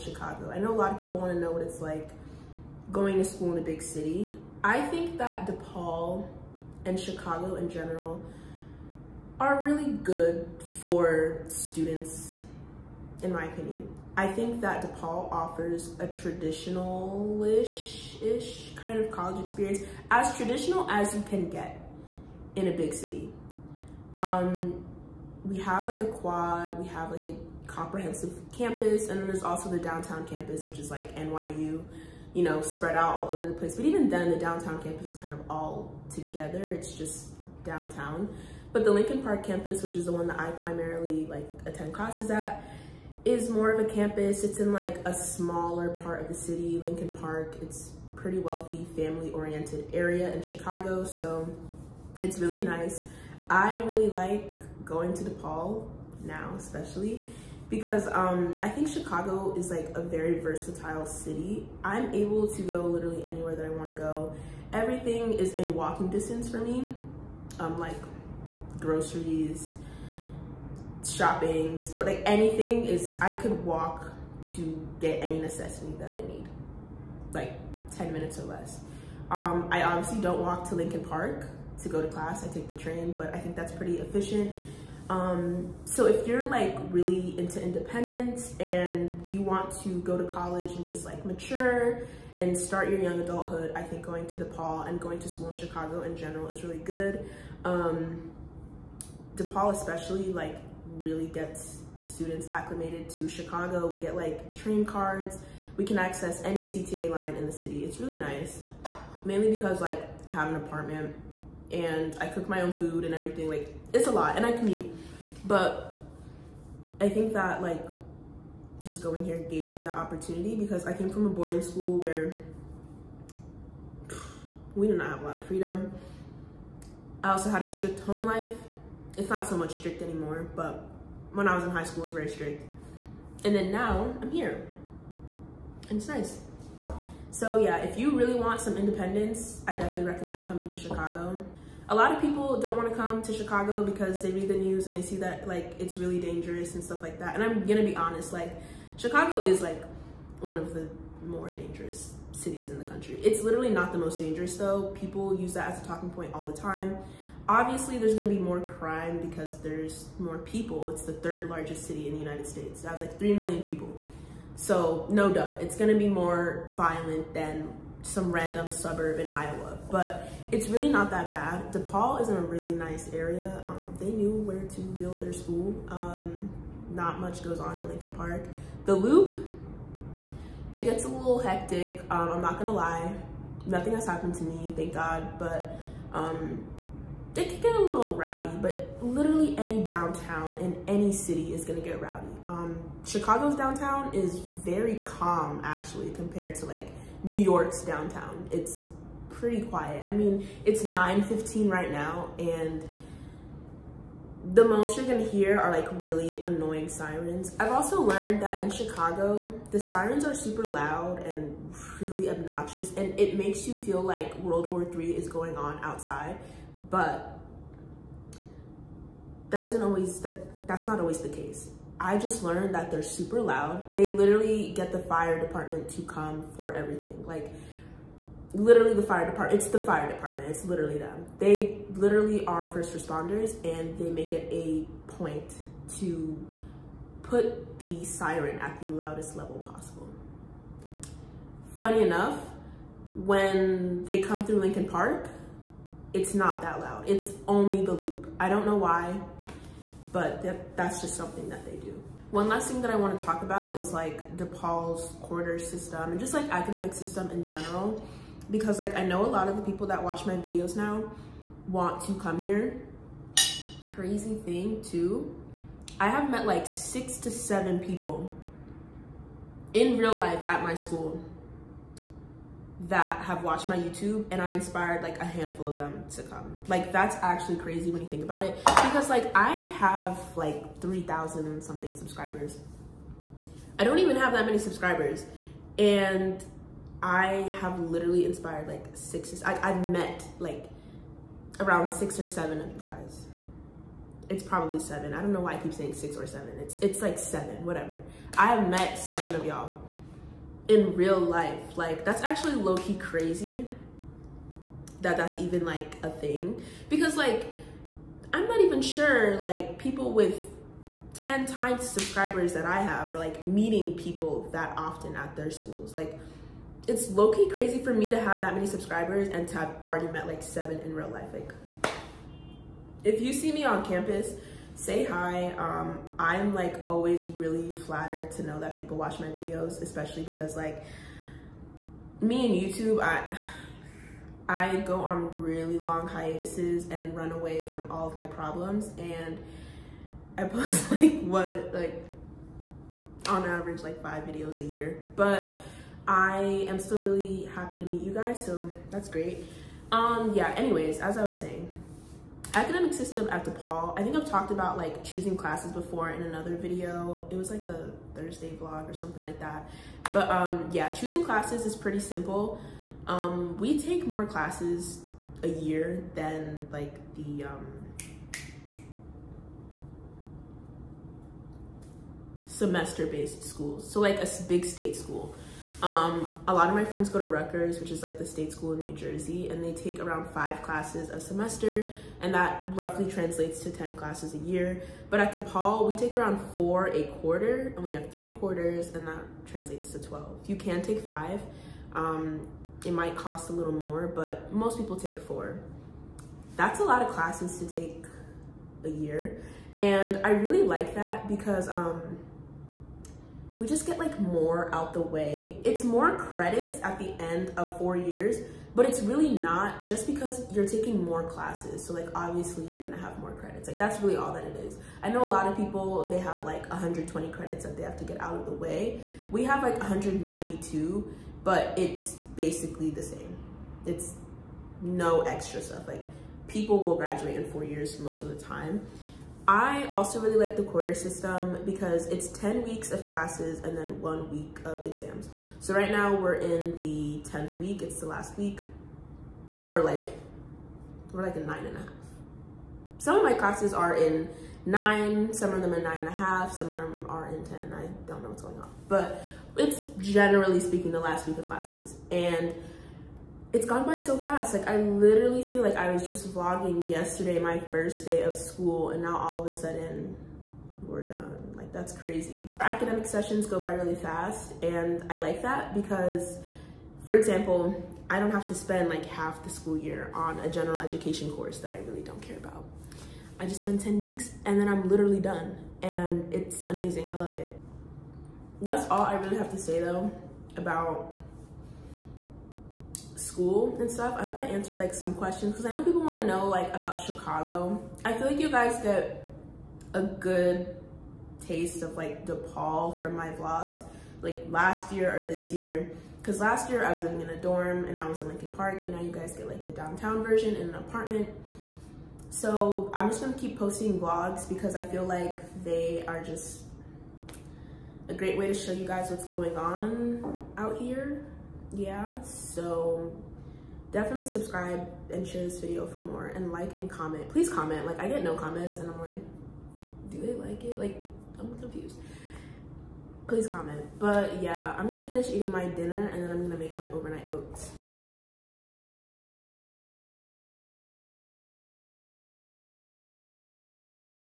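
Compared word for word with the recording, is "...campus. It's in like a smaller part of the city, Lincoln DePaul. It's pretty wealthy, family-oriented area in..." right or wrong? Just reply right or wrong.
wrong.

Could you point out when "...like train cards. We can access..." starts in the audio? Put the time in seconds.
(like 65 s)
104 s.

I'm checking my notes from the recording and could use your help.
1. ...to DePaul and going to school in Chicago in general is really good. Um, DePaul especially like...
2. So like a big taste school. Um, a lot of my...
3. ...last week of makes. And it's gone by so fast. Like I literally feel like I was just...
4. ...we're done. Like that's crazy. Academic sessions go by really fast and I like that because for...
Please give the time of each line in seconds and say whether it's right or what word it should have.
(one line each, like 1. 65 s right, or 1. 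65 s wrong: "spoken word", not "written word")
1. 94 s right
2. 373 s wrong: "state", not "taste"
3. 450 s wrong: "classes", not "makes"
4. 460 s right.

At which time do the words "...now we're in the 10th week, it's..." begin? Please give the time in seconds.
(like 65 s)
435 s.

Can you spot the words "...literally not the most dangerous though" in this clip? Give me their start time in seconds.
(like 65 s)
153 s.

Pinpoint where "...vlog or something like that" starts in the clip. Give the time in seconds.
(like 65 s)
358 s.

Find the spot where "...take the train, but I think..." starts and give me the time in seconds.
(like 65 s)
82 s.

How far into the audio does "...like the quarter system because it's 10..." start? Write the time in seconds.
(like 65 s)
430 s.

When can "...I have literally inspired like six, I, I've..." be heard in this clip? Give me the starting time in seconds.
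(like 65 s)
287 s.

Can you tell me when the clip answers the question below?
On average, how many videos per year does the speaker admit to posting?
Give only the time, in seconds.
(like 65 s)
344 s.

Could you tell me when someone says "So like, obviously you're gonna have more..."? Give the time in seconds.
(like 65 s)
411 s.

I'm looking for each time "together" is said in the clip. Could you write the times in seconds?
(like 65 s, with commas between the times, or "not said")
36 s.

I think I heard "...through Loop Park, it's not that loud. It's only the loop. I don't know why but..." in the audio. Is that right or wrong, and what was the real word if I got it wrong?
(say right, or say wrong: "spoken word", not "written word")
wrong: "Lincoln", not "Loop".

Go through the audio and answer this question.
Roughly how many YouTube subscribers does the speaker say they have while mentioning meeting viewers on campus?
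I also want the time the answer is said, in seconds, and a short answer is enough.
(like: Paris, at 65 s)
3,000, at 280 s.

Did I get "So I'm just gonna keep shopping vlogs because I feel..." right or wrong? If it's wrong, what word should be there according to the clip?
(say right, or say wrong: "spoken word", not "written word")
wrong: "posting", not "shopping".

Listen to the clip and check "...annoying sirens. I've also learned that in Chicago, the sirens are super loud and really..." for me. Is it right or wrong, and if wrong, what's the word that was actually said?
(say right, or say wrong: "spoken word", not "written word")
right.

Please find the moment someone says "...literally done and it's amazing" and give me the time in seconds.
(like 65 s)
474 s.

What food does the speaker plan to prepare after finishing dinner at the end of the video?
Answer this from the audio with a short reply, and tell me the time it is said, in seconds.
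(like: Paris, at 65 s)
Overnight oats, at 526 s.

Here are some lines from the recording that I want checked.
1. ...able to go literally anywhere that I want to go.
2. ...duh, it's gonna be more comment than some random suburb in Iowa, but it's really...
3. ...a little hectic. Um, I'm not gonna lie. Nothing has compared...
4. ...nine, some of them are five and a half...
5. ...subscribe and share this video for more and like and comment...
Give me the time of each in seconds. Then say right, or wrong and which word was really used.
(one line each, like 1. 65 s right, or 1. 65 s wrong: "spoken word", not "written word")
1. 62 s right
2. 165 s wrong: "violent", not "comment"
3. 181 s wrong: "happened", not "compared"
4. 444 s wrong: "nine", not "five"
5. 514 s right.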